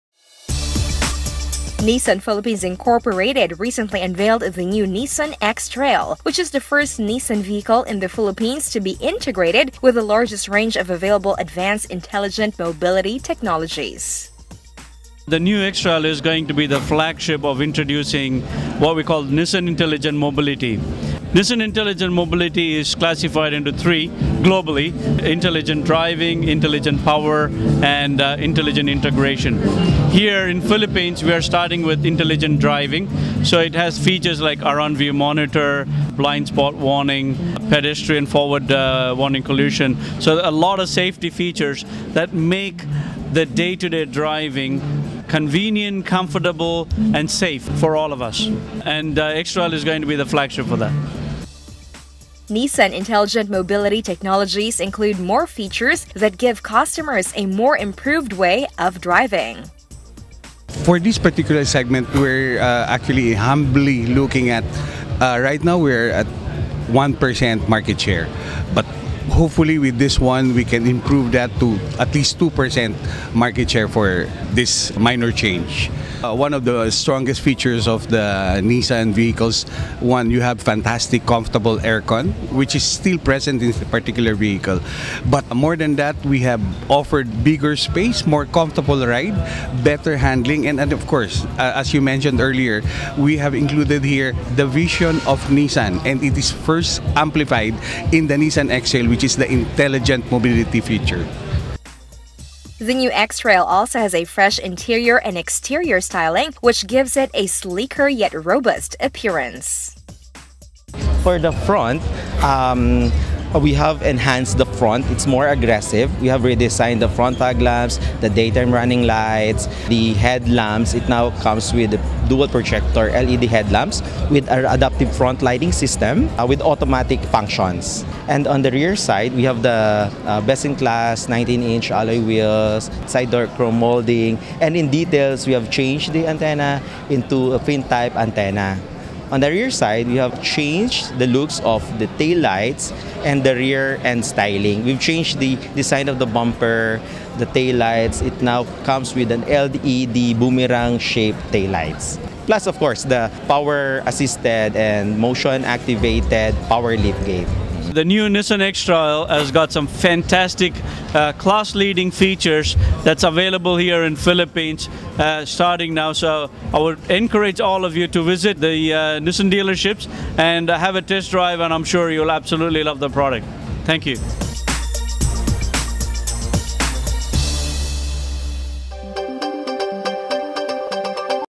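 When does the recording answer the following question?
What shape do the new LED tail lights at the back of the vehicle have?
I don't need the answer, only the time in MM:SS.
02:30.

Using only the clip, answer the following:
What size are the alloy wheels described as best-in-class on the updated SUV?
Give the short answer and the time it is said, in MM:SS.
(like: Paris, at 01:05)
19-inch, at 02:11.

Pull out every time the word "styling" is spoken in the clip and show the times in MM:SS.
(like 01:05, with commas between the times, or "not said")
01:46, 02:24.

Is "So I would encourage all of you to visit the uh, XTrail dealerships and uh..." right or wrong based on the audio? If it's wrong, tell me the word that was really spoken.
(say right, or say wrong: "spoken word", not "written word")
wrong: "Nissan", not "XTrail".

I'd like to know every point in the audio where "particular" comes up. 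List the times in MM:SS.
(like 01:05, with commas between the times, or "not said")
01:01, 01:23.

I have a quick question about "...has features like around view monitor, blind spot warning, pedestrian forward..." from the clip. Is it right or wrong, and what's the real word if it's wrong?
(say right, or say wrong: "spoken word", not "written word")
right.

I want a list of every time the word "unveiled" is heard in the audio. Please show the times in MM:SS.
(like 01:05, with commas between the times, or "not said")
00:04.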